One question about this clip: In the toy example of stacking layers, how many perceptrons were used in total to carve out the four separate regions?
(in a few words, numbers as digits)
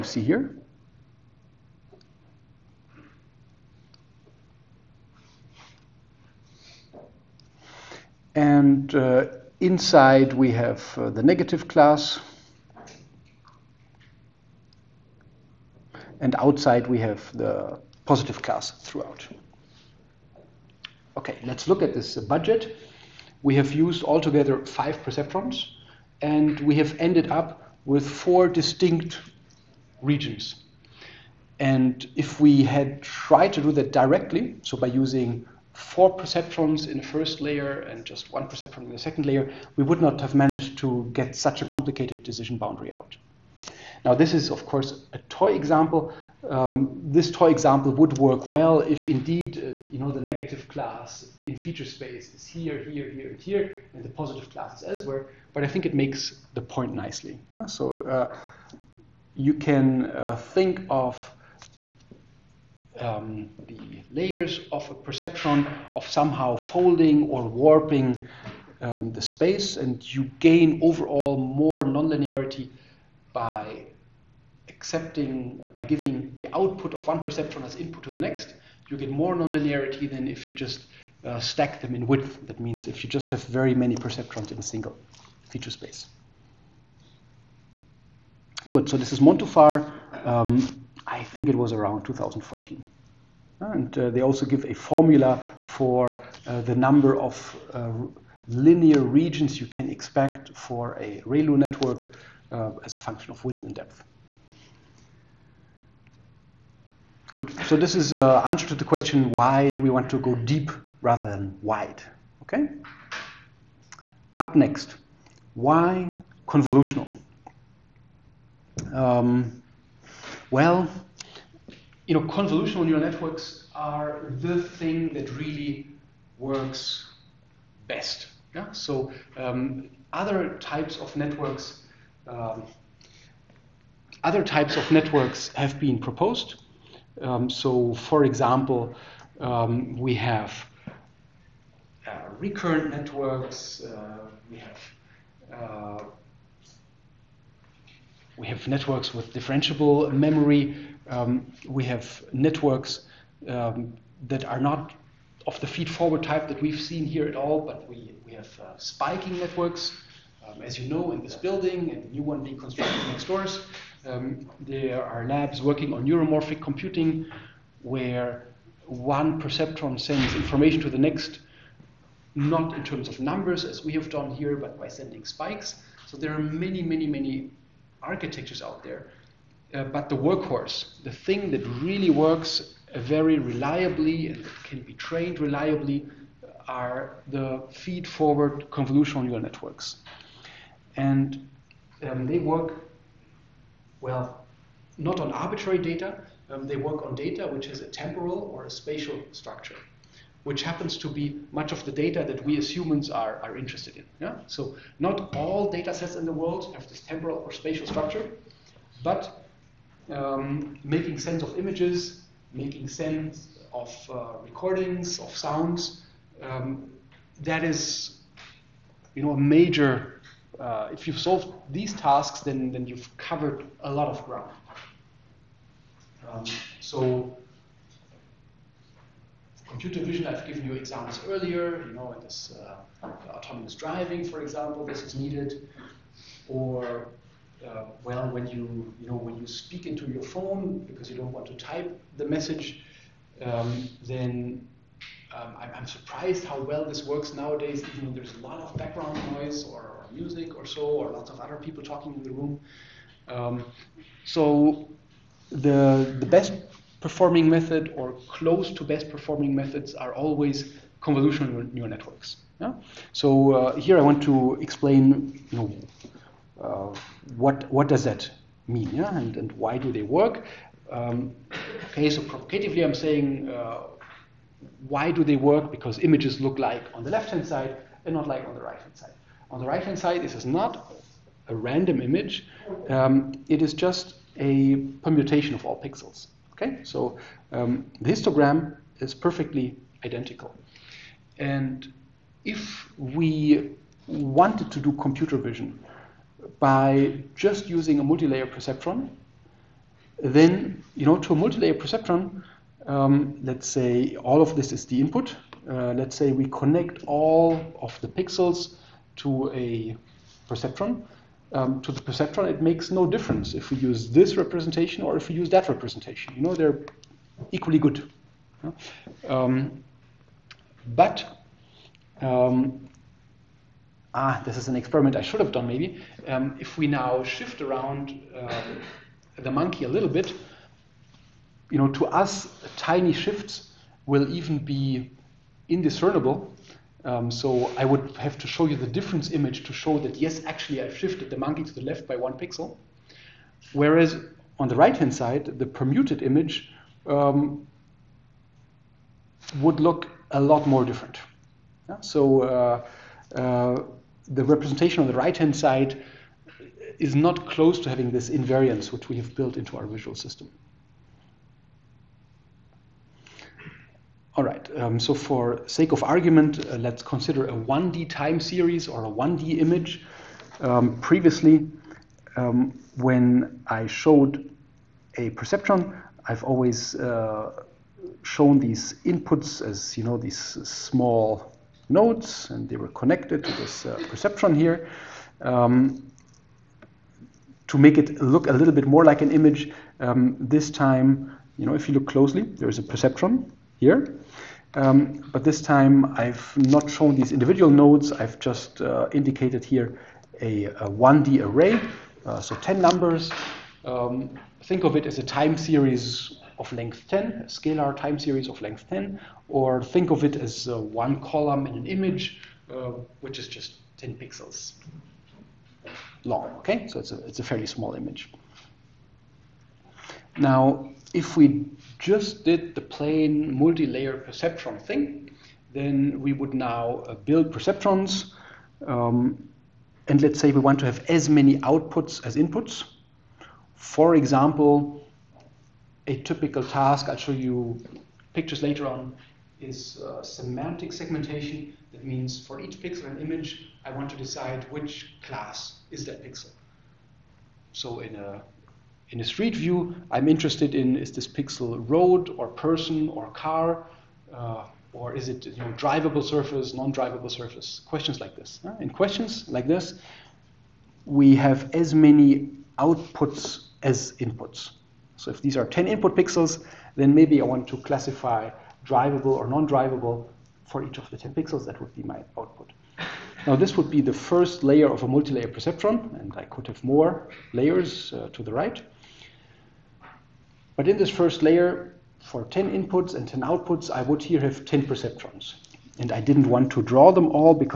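5.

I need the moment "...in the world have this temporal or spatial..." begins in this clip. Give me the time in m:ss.
3:26.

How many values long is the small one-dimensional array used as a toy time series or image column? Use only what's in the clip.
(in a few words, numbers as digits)
10.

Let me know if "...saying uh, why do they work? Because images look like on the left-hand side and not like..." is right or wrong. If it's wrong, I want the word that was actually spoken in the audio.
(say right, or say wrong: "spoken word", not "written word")
right.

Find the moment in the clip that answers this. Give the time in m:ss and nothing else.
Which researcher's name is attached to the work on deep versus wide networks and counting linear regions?
1:29.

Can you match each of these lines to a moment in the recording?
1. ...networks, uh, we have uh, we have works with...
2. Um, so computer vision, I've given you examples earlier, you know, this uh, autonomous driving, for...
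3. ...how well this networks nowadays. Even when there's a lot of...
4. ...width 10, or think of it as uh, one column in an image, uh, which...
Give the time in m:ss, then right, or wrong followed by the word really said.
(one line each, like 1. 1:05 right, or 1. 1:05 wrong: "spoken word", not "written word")
1. 2:22 wrong: "networks", not "works"
2. 3:46 right
3. 4:06 wrong: "works", not "networks"
4. 6:48 wrong: "length", not "width".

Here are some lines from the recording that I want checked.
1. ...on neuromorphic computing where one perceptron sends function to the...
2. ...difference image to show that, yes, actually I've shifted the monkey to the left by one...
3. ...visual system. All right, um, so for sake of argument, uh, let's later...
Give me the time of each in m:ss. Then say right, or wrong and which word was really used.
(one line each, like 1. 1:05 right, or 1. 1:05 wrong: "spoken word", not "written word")
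1. 2:45 wrong: "information", not "function"
2. 5:38 right
3. 5:59 wrong: "consider", not "later".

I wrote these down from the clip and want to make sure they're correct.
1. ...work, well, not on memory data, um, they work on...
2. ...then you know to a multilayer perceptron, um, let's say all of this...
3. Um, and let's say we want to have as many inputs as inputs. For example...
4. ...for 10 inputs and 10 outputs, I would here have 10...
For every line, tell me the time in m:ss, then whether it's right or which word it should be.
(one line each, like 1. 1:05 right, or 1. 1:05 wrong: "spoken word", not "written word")
1. 3:12 wrong: "arbitrary", not "memory"
2. 5:00 right
3. 7:08 wrong: "outputs", not "inputs"
4. 8:02 right.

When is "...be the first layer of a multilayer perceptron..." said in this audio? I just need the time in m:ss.
7:53.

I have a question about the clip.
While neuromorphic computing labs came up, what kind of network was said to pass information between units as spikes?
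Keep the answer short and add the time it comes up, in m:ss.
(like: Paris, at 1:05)
spiking networks, at 2:38.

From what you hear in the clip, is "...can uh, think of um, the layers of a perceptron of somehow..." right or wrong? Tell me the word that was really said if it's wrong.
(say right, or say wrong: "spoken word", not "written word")
right.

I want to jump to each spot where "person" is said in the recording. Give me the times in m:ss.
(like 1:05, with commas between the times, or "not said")
7:32.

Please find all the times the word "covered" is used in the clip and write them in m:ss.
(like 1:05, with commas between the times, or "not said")
3:43.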